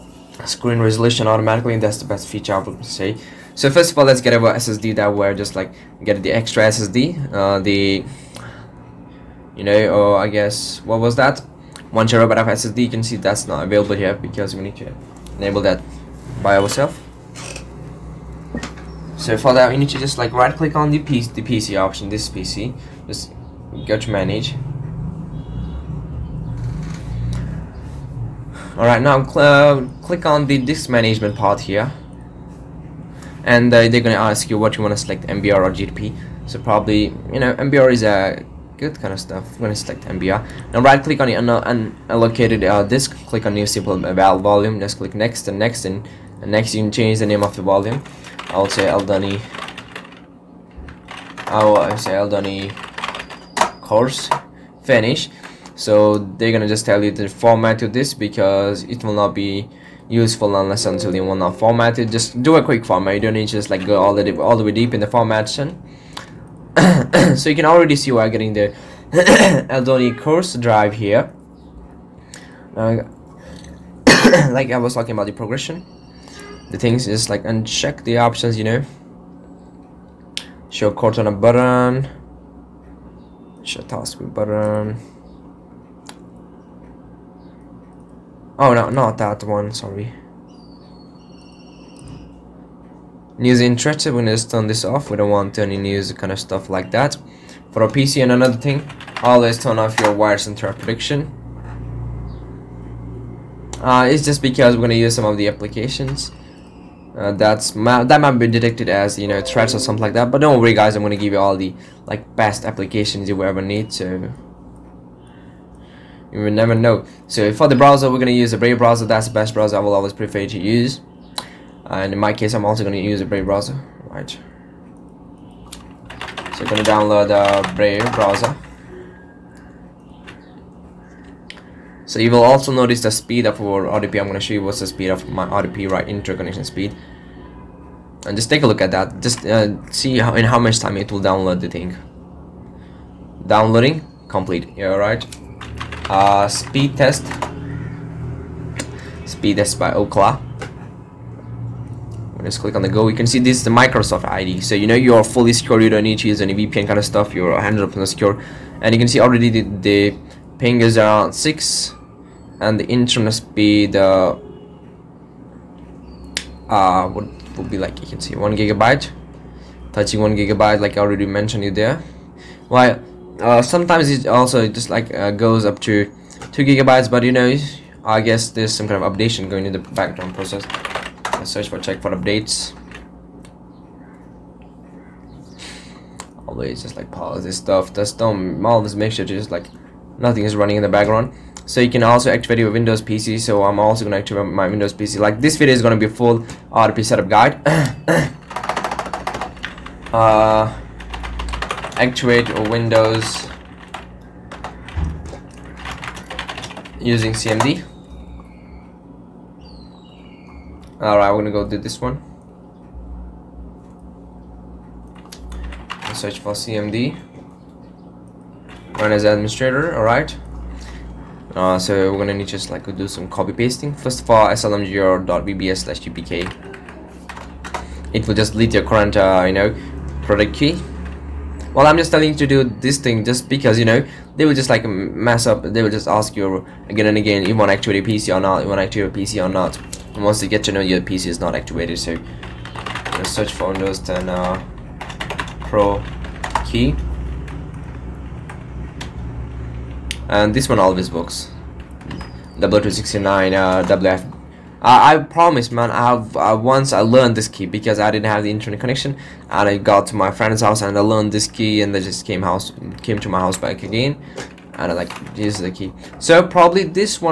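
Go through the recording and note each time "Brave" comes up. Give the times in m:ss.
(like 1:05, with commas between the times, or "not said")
1:58, 2:03, 2:07.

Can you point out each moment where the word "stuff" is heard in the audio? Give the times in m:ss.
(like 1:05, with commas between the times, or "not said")
0:39, 1:36, 2:37, 3:07.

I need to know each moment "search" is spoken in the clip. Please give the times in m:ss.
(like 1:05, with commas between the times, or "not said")
3:01, 3:36, 4:03.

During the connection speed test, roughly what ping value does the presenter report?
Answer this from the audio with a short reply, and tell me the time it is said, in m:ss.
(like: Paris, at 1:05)
6, at 2:40.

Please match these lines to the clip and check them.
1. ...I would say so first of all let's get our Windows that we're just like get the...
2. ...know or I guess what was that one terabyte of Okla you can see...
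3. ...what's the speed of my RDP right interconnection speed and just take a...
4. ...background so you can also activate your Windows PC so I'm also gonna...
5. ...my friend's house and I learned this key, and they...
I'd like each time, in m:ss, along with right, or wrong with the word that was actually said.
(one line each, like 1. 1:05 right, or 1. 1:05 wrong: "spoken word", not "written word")
1. 0:02 wrong: "SSD", not "Windows"
2. 0:09 wrong: "SSD", not "Okla"
3. 2:14 right
4. 3:10 right
5. 4:20 right.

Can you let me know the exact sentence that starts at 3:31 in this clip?
Alright, we're gonna go do this one.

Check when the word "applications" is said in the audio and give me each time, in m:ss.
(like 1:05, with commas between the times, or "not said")
1:45, 1:52.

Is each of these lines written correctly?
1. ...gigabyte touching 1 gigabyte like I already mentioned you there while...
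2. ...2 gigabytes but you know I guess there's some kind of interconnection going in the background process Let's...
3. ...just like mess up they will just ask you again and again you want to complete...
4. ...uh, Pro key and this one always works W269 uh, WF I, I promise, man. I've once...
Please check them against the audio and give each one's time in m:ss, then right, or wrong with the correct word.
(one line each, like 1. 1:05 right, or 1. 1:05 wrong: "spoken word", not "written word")
1. 2:48 right
2. 2:56 wrong: "updation", not "interconnection"
3. 3:54 wrong: "activate", not "complete"
4. 4:04 right.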